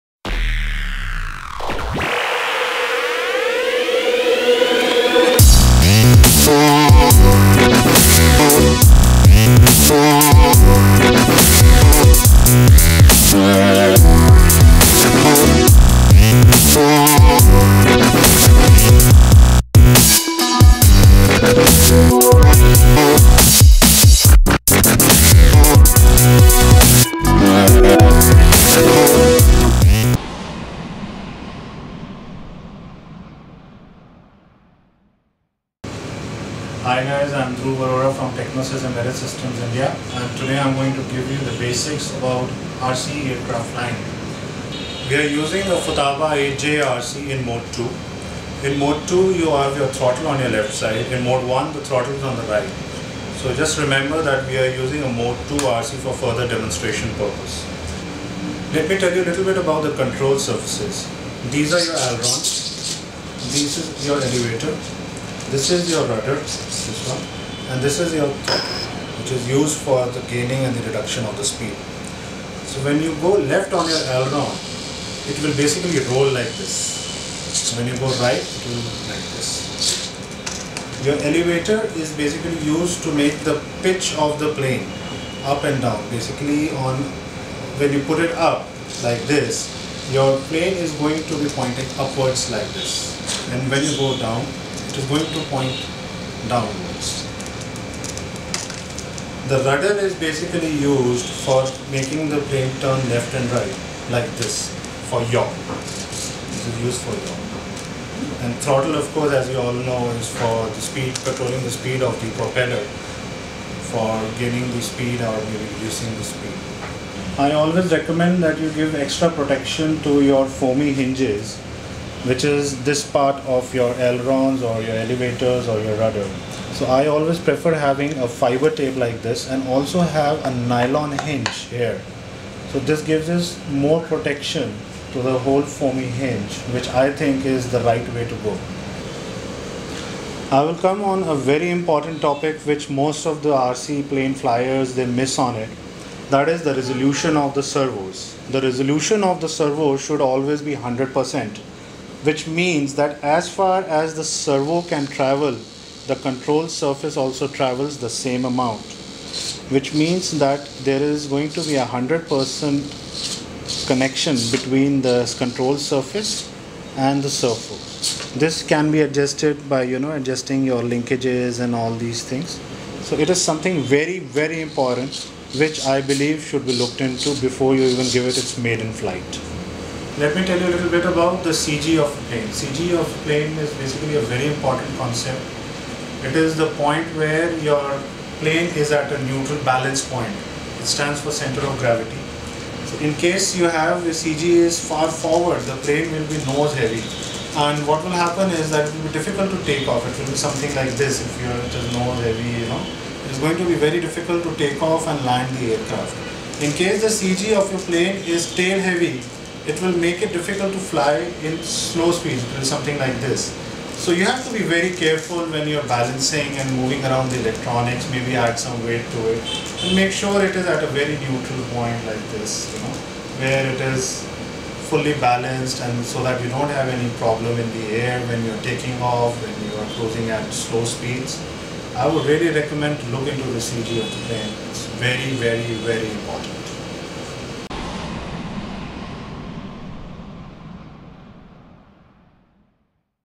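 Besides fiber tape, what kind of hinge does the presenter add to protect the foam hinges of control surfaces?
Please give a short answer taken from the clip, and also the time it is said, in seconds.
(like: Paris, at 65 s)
nylon hinge, at 130 s.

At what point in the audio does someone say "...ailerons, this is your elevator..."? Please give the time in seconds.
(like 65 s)
62 s.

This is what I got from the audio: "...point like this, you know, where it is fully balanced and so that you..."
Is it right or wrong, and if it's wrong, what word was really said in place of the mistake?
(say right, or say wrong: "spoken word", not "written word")
right.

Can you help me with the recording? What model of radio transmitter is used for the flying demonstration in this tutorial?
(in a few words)
Futaba 8J.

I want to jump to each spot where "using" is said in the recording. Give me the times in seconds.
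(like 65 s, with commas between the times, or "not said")
45 s, 54 s.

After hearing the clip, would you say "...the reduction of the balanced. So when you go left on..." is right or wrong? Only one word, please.
wrong.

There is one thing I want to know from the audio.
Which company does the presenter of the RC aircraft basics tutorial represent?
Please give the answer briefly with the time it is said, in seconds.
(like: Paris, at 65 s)
Technosys Embedded Systems India, at 38 s.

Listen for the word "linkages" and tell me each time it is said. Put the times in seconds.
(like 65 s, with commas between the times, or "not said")
170 s.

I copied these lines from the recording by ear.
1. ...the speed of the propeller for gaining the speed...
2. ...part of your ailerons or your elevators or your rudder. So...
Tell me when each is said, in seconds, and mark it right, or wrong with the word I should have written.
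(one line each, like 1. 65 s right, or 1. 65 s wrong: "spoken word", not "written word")
1. 111 s right
2. 123 s right.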